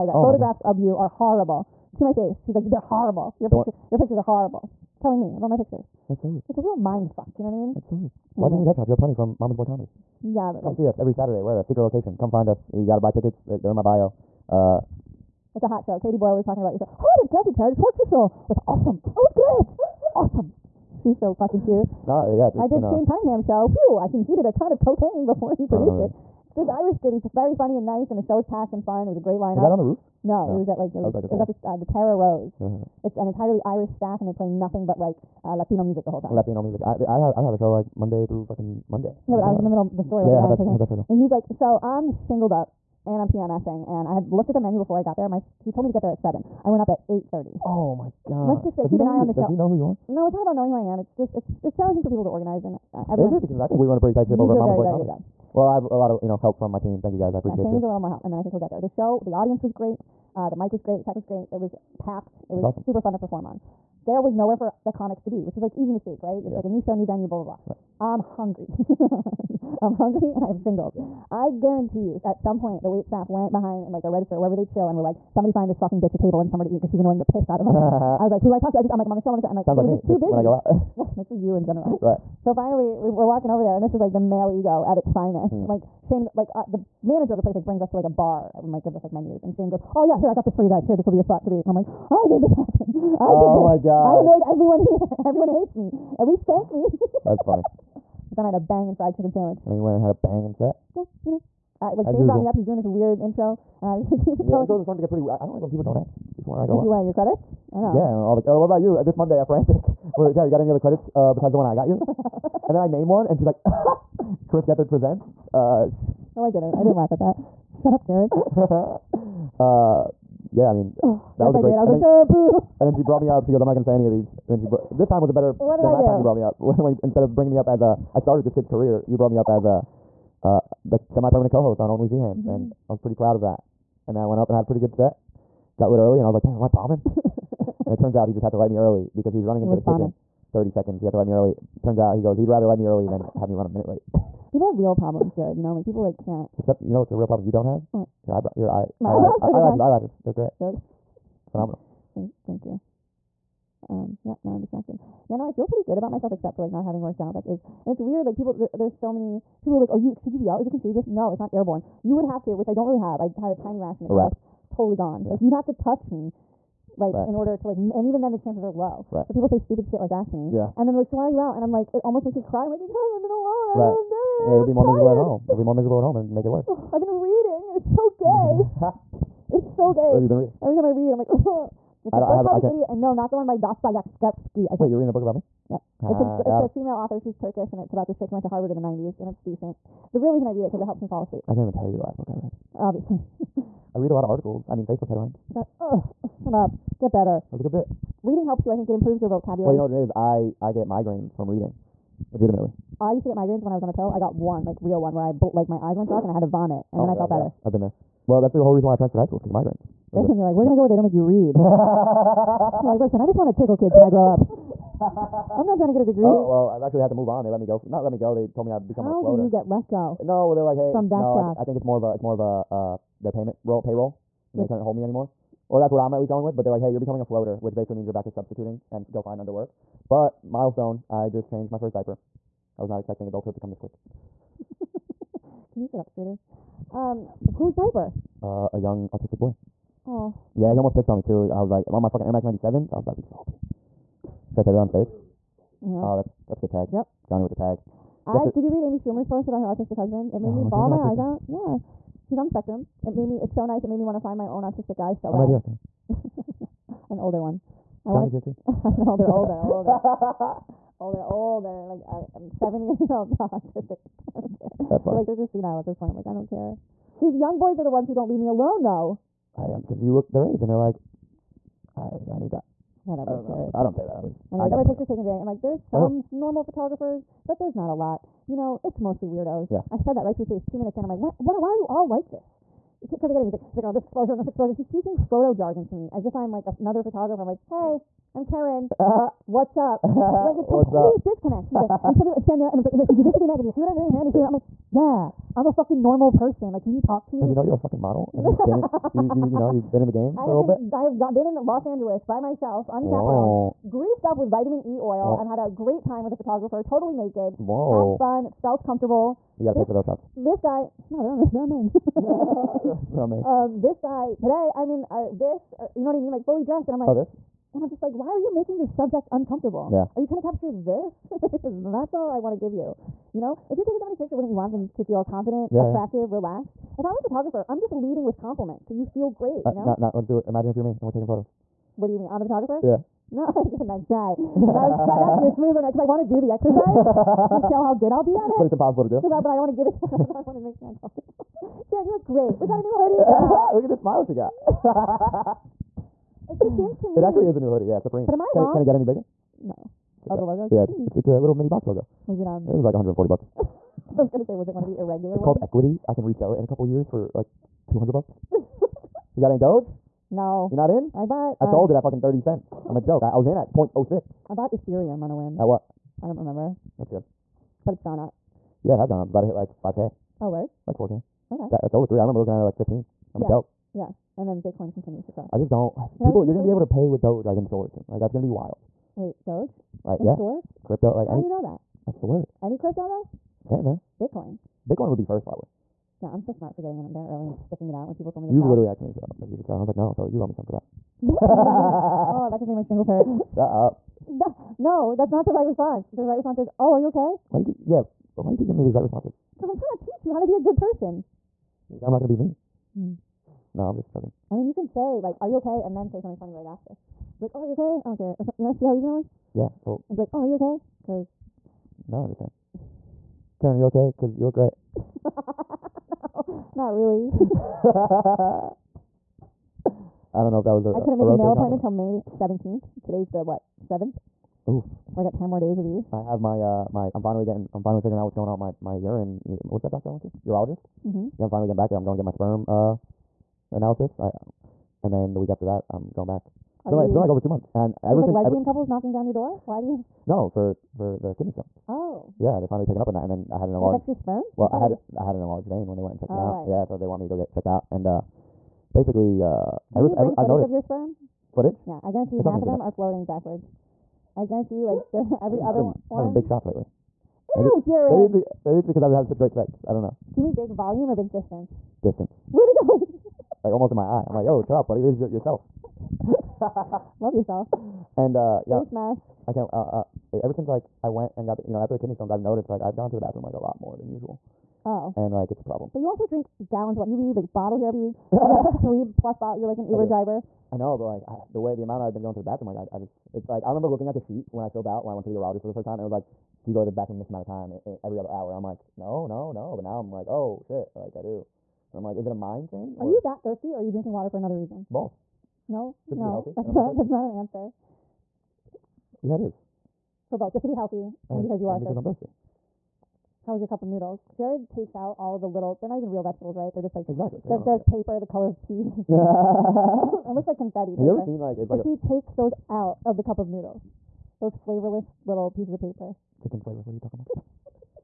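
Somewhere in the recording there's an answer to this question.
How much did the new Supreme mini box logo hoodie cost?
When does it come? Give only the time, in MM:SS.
05:52.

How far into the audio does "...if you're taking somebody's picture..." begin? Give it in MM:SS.
05:23.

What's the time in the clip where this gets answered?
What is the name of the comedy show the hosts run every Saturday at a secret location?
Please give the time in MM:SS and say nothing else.
00:09.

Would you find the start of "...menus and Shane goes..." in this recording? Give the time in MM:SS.
01:29.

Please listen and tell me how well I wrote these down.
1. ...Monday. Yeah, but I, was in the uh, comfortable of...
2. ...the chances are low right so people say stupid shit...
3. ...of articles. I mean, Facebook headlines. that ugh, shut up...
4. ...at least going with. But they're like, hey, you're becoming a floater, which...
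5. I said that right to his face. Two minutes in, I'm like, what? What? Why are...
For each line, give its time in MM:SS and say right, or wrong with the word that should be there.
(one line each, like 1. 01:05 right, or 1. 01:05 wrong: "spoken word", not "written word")
1. 00:38 wrong: "middle", not "comfortable"
2. 02:48 right
3. 03:14 right
4. 03:46 right
5. 04:39 right.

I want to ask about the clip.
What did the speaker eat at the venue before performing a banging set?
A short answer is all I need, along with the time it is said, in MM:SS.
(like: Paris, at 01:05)
fried chicken sandwich, at 01:38.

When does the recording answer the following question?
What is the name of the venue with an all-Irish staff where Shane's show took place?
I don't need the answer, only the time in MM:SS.
00:31.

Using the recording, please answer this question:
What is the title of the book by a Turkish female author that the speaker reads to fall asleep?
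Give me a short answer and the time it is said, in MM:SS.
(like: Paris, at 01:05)
The Idiot, at 03:02.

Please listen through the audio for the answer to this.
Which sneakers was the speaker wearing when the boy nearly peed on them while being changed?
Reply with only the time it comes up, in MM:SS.
04:02.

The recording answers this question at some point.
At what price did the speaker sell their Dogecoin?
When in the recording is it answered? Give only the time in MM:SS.
06:02.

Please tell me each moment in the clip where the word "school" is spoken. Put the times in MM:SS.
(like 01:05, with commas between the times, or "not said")
03:29.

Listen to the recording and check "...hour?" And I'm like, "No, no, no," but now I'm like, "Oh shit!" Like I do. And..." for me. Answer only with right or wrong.
right.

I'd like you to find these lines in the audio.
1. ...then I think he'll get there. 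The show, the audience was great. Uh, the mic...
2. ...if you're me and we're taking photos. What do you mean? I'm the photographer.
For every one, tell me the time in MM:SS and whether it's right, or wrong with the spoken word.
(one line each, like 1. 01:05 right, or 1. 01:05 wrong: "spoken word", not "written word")
1. 00:58 right
2. 05:30 right.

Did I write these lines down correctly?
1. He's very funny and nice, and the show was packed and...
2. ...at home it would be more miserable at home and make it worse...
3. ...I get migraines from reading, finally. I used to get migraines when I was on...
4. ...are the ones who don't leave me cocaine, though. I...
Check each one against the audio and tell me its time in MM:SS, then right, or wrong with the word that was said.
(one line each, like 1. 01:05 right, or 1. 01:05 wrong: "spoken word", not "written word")
1. 00:27 right
2. 02:55 right
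3. 03:20 wrong: "legitimately", not "finally"
4. 04:27 wrong: "alone", not "cocaine".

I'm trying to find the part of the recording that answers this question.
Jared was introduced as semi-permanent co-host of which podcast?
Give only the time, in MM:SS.
02:11.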